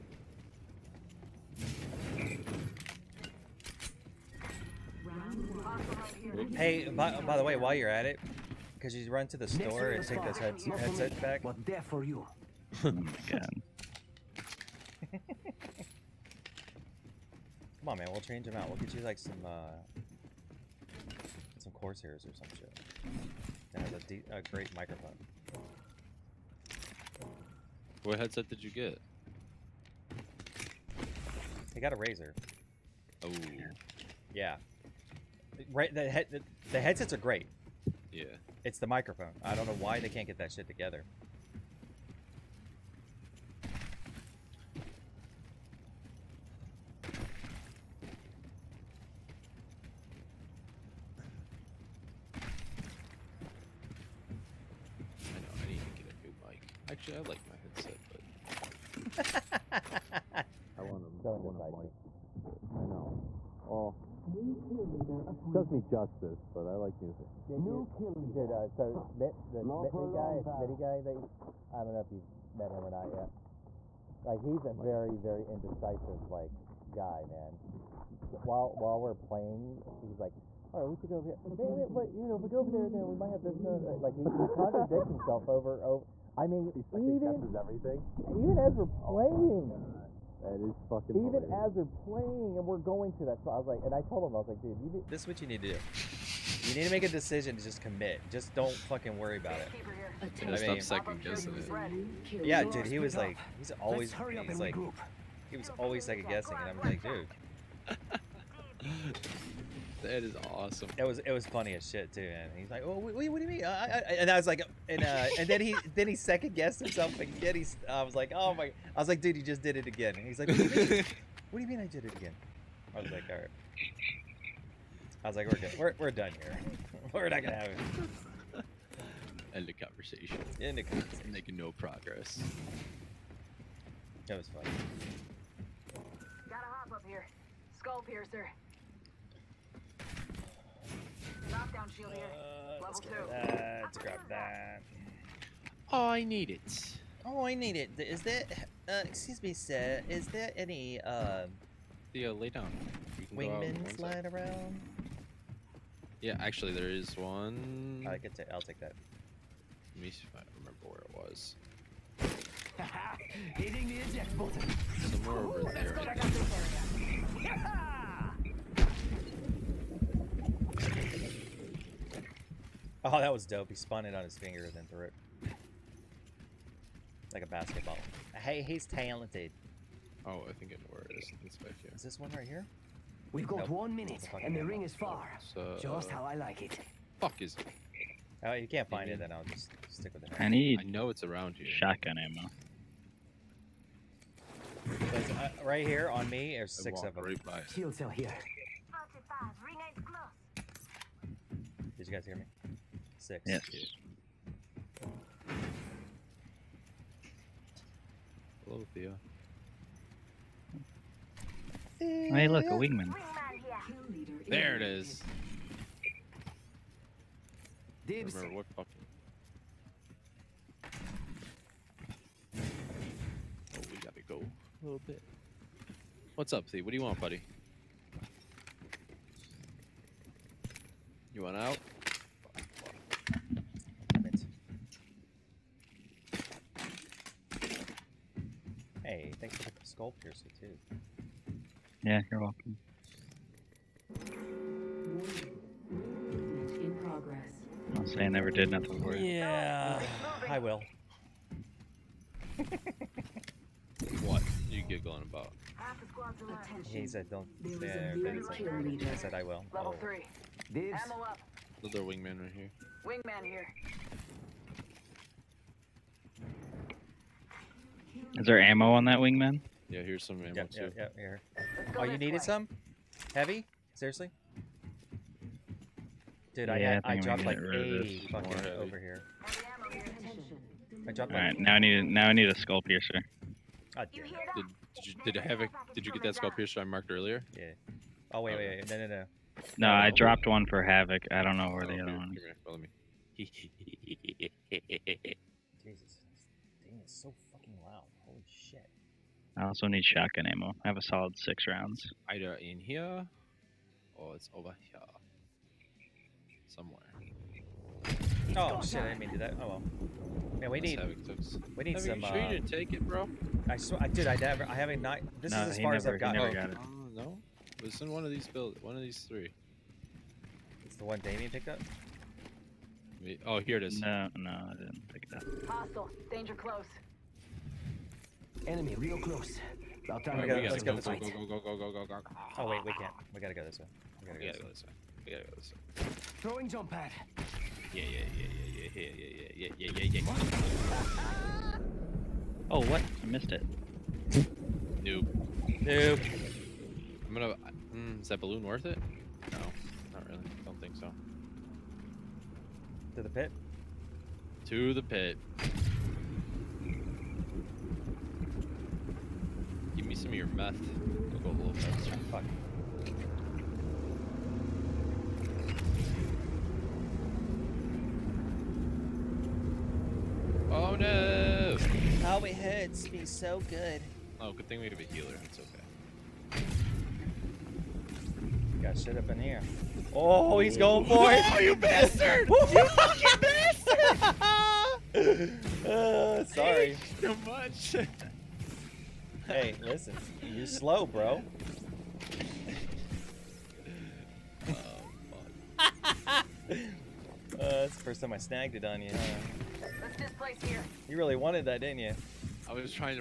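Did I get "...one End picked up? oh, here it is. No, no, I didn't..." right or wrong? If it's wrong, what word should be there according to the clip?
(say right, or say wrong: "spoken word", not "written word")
wrong: "Damien", not "End".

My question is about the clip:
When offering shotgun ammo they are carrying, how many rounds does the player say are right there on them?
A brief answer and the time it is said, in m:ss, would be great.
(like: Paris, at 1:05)
6, at 3:16.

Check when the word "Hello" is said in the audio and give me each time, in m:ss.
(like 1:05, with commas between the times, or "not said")
3:28.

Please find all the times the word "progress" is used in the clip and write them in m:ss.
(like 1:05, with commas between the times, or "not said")
2:11, 4:07.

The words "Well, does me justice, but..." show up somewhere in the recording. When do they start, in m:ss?
1:03.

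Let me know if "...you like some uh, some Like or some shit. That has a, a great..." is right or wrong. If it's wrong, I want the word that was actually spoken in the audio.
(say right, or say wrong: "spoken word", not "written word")
wrong: "Corsairs", not "Like".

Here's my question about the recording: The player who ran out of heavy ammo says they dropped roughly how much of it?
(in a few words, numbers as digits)
80.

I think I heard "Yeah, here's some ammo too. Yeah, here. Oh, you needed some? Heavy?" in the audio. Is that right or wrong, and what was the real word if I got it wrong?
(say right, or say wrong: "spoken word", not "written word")
right.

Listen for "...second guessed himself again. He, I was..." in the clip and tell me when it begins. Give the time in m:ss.
1:56.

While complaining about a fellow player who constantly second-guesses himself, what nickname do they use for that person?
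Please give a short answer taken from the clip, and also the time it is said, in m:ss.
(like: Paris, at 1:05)
Smitty, at 1:10.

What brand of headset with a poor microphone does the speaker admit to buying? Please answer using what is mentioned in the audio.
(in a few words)
Razer.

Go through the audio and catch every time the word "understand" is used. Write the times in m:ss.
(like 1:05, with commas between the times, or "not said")
not said.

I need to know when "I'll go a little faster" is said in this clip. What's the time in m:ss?
6:01.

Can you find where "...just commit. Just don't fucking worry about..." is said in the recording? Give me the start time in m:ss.
1:37.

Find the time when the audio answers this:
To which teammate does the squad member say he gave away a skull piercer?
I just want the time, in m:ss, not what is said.
4:49.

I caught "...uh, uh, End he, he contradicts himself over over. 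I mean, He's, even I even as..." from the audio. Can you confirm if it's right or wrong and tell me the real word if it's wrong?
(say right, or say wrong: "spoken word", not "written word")
wrong: "Like", not "End".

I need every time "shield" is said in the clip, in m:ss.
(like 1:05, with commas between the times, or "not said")
2:21, 3:17.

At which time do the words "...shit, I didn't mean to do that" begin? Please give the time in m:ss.
5:08.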